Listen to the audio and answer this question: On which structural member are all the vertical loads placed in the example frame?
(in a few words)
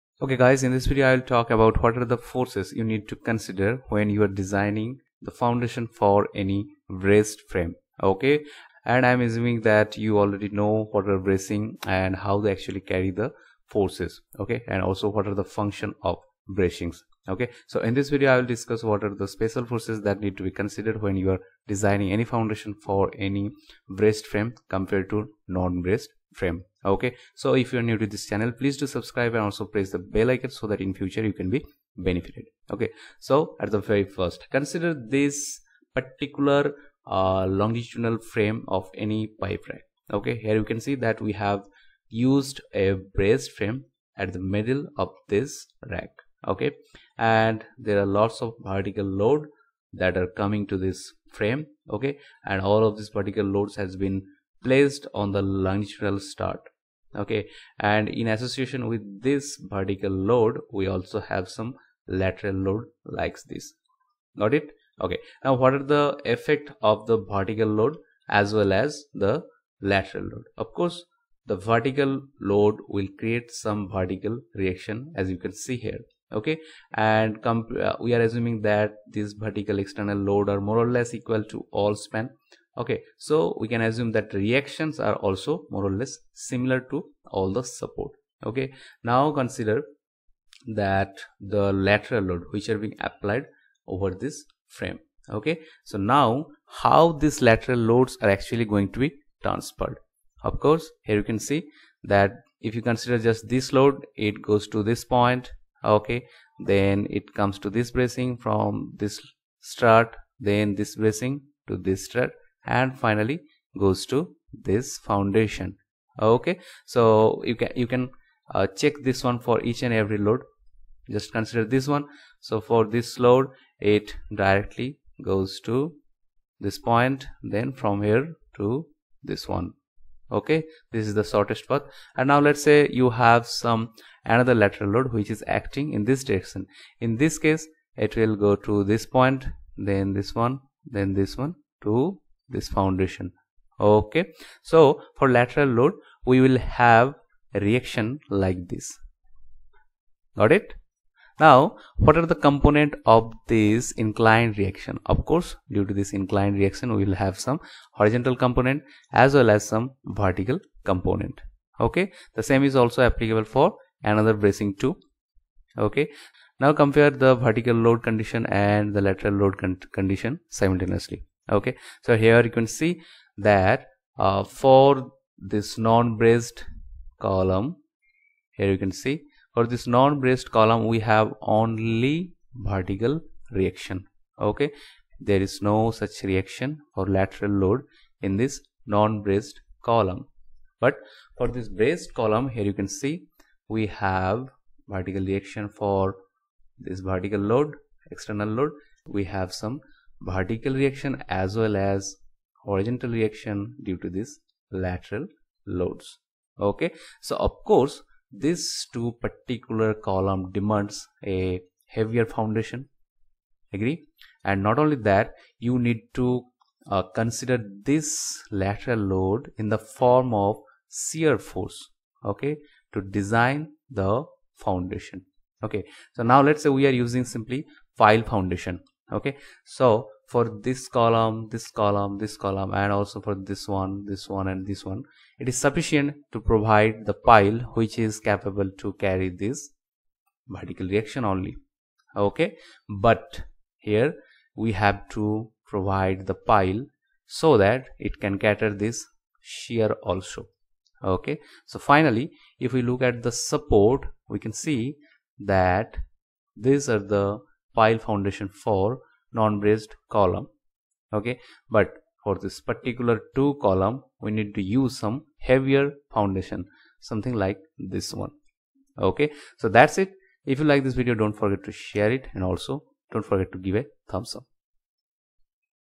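Longitudinal strut.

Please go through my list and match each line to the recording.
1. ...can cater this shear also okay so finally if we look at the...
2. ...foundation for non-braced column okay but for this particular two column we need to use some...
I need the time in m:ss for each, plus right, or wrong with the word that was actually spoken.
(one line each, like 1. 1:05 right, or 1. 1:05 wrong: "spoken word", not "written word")
1. 4:08 right
2. 4:18 right.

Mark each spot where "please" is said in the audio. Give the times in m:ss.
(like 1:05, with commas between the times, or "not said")
0:28.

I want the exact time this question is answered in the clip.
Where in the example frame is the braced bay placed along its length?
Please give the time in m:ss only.
0:44.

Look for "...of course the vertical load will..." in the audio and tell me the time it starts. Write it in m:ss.
1:10.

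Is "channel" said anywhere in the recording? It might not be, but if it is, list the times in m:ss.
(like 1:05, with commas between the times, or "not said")
0:28.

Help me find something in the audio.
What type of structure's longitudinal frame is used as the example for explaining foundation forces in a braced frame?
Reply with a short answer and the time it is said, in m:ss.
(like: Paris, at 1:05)
Pipe rack, at 0:39.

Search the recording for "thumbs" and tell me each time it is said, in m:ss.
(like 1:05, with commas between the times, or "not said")
4:34.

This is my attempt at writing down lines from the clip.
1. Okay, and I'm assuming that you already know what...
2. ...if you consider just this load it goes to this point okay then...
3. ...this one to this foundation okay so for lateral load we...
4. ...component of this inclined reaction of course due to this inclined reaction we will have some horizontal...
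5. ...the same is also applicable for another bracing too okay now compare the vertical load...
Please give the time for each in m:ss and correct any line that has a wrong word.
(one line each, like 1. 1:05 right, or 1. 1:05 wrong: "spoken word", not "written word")
1. 0:08 right
2. 1:42 right
3. 2:21 right
4. 2:32 right
5. 2:42 right.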